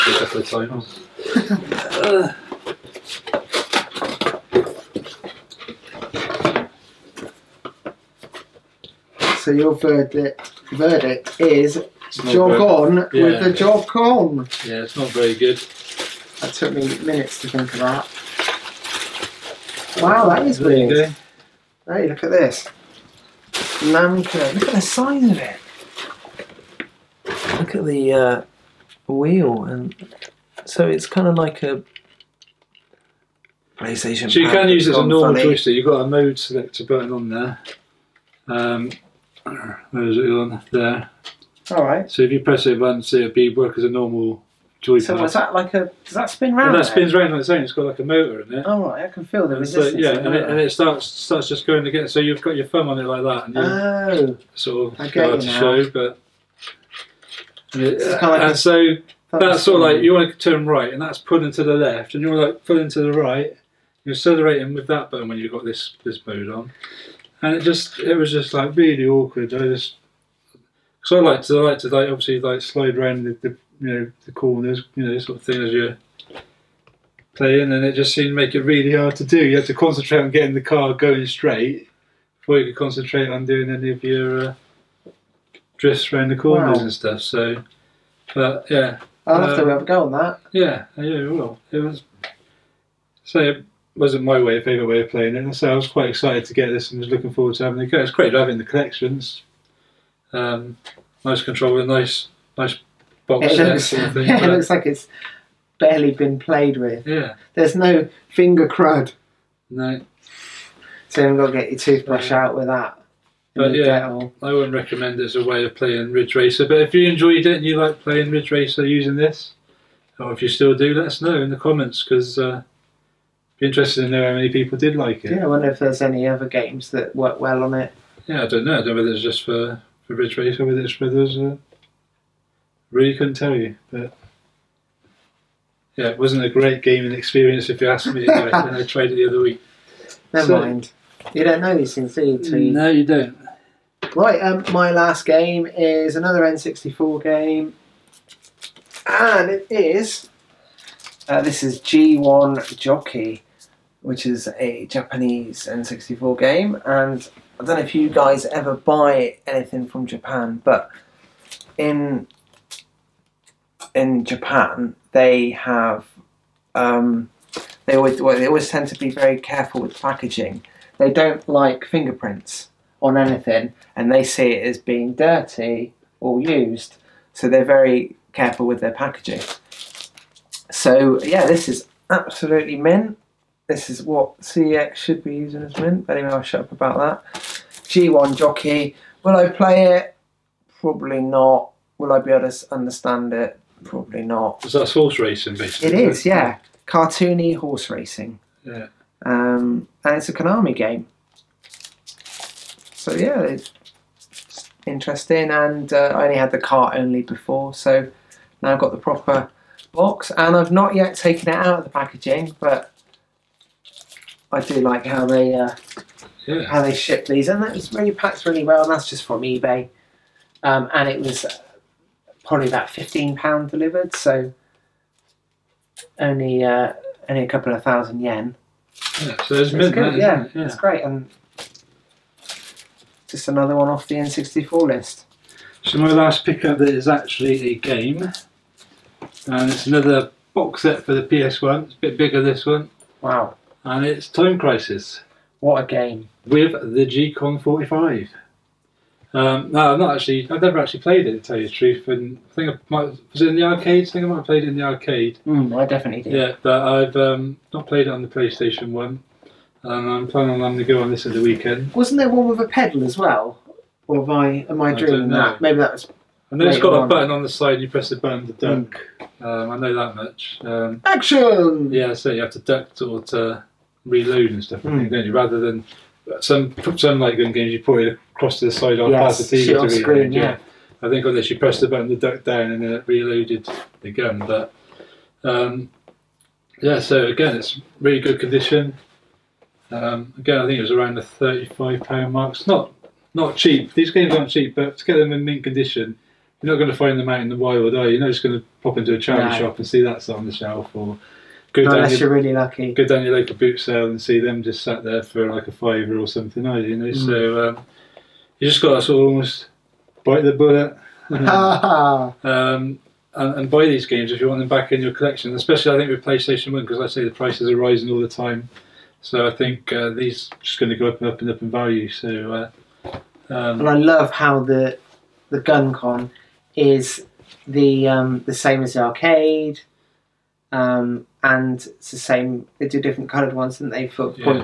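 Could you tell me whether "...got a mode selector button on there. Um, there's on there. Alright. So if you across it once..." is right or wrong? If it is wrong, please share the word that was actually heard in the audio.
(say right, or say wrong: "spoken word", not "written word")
wrong: "press", not "across".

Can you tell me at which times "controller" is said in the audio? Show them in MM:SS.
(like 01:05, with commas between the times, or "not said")
01:41.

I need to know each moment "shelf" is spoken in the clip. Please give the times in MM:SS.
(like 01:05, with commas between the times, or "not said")
05:00.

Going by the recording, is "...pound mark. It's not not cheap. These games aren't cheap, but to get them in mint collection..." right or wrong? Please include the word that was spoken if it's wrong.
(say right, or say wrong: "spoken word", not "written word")
wrong: "condition", not "collection".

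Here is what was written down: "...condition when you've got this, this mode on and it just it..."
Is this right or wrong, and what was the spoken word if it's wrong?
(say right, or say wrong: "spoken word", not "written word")
wrong: "button", not "condition".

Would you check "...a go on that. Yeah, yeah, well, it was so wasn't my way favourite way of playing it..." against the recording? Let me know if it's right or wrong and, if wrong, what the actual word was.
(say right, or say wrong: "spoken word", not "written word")
right.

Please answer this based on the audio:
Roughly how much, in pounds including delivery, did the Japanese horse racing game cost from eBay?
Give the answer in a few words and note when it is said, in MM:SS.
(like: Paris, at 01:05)
£15, at 03:42.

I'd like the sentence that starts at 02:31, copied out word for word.
Uh, this is G1 Jockey which is a Japanese N64 game.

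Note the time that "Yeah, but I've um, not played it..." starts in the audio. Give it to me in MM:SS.
04:16.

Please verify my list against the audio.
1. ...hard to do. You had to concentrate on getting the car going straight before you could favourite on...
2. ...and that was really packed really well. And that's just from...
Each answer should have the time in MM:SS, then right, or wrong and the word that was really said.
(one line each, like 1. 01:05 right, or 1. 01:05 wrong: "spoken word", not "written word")
1. 01:18 wrong: "concentrate", not "favourite"
2. 03:37 right.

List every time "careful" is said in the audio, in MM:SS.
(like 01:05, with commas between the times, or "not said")
02:49, 02:58.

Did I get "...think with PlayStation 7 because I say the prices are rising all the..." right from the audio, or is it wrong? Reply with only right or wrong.
wrong.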